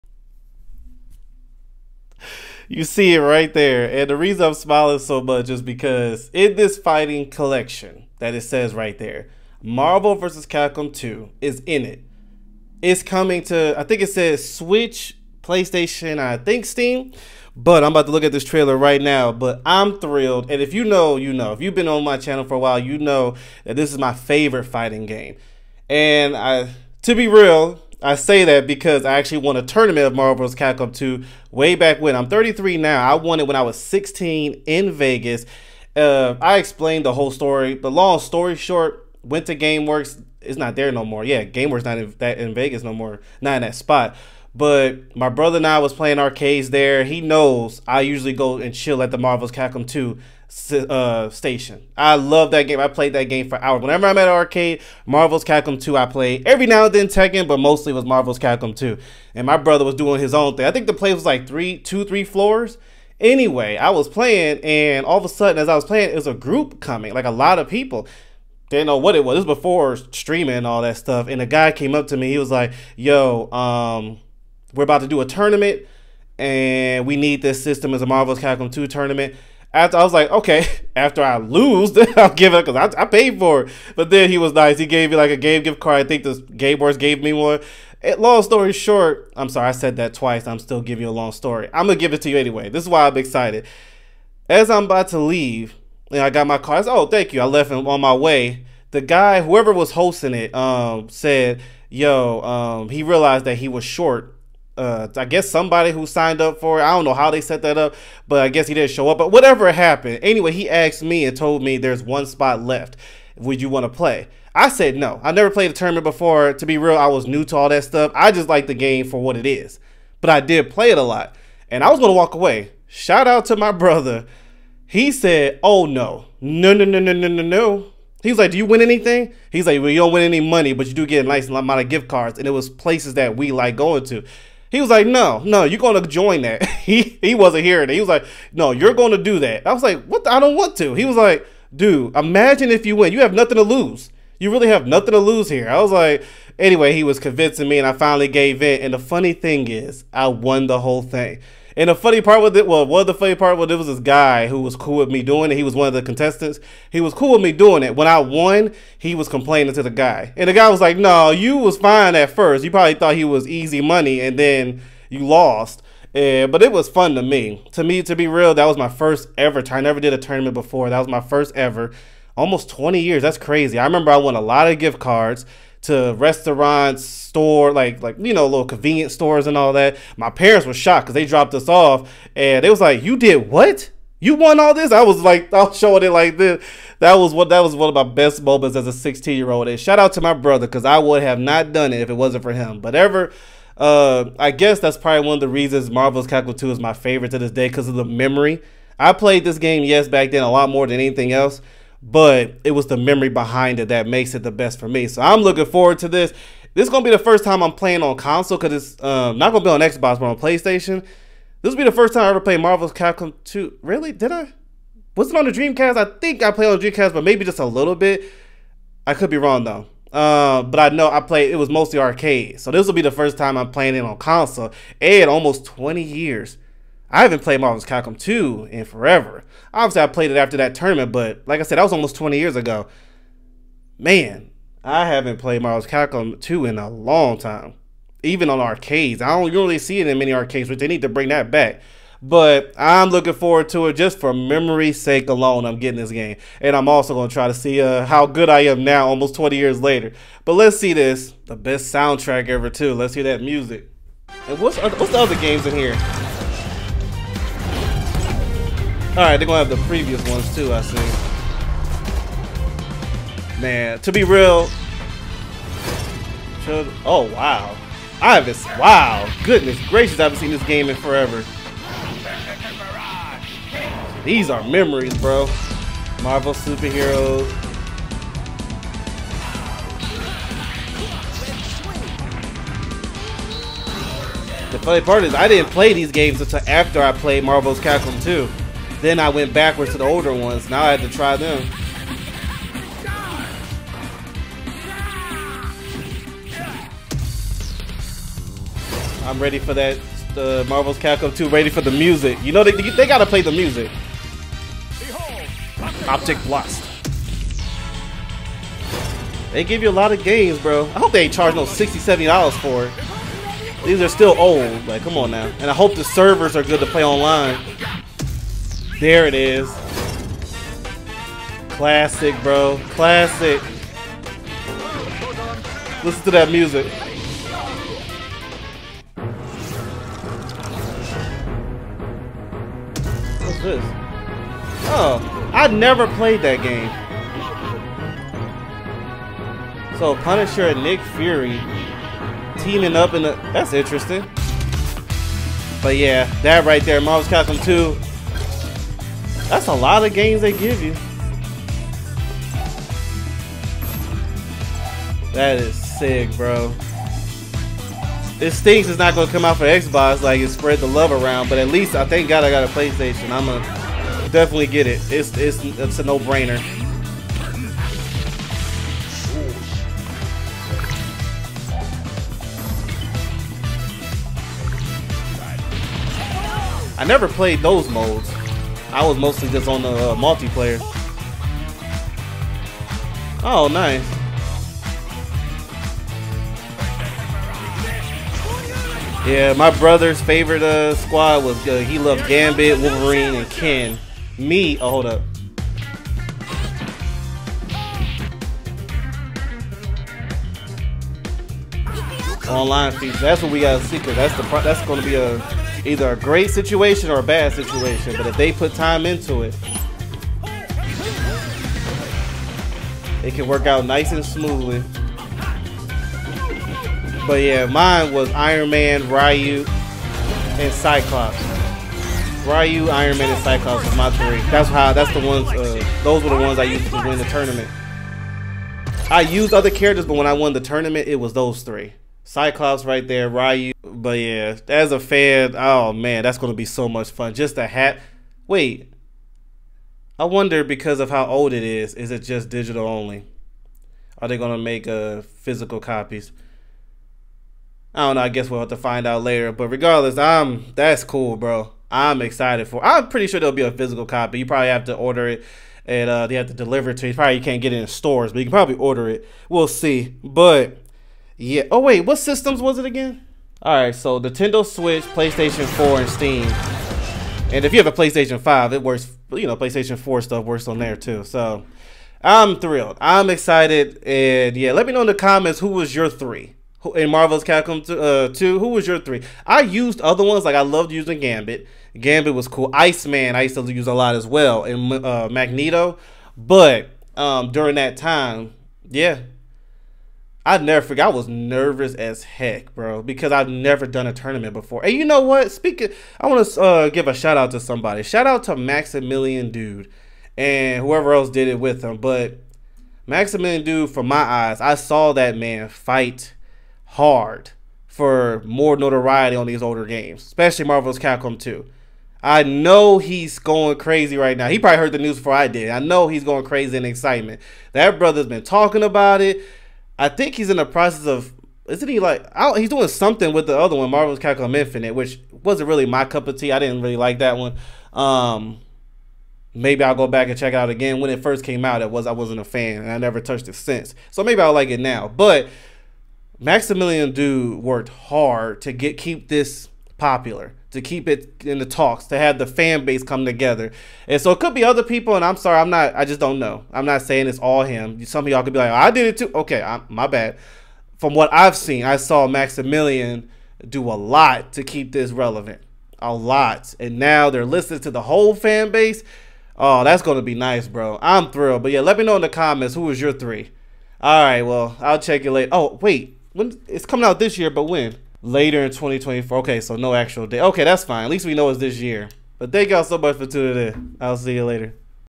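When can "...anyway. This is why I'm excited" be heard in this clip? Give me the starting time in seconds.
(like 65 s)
92 s.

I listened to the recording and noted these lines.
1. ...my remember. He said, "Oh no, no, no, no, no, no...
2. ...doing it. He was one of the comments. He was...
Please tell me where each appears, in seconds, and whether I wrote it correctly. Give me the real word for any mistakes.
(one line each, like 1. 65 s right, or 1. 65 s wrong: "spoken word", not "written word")
1. 123 s wrong: "brother", not "remember"
2. 155 s wrong: "contestants", not "comments".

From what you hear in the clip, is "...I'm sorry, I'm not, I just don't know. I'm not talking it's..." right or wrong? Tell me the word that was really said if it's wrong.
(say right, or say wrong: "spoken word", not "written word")
wrong: "saying", not "talking".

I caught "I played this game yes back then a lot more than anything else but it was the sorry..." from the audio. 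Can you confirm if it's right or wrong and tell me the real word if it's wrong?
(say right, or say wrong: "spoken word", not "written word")
wrong: "memory", not "sorry".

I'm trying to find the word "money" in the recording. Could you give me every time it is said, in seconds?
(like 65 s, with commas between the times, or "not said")
130 s, 163 s.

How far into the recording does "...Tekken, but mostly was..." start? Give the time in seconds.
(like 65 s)
57 s.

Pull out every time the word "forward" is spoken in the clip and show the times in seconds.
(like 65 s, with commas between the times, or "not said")
205 s, 243 s.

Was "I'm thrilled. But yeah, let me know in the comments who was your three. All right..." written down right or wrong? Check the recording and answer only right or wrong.
right.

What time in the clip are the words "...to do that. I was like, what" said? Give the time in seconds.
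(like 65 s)
139 s.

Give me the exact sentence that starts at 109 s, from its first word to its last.
But whatever happened, anyway, he asked me and told me there's one spot left.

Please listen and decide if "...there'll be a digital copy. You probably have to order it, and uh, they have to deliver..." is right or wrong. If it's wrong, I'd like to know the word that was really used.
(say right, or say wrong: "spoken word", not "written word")
wrong: "physical", not "digital".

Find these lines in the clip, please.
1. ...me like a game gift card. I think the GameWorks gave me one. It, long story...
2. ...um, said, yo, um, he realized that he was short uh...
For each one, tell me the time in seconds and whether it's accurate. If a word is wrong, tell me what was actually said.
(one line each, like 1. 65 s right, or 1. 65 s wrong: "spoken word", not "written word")
1. 85 s right
2. 100 s right.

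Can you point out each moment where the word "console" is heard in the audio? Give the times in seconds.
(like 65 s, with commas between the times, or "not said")
208 s, 224 s.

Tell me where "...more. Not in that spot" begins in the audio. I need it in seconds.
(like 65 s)
42 s.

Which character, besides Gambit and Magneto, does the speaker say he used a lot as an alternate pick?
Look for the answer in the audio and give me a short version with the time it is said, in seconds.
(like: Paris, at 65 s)
Iceman, at 482 s.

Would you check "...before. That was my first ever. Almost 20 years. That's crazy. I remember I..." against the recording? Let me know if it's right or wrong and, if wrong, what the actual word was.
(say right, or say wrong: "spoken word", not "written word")
right.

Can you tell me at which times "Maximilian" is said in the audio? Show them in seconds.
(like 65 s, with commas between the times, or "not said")
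498 s, 503 s, 536 s, 552 s.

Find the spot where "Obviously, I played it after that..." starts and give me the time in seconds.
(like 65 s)
229 s.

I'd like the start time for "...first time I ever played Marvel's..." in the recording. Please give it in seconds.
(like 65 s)
211 s.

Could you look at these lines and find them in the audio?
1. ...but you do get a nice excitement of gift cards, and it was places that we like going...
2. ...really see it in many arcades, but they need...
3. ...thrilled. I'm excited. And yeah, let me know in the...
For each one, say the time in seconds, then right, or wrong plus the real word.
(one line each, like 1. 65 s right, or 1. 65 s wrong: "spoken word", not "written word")
1. 130 s wrong: "amount", not "excitement"
2. 239 s right
3. 472 s right.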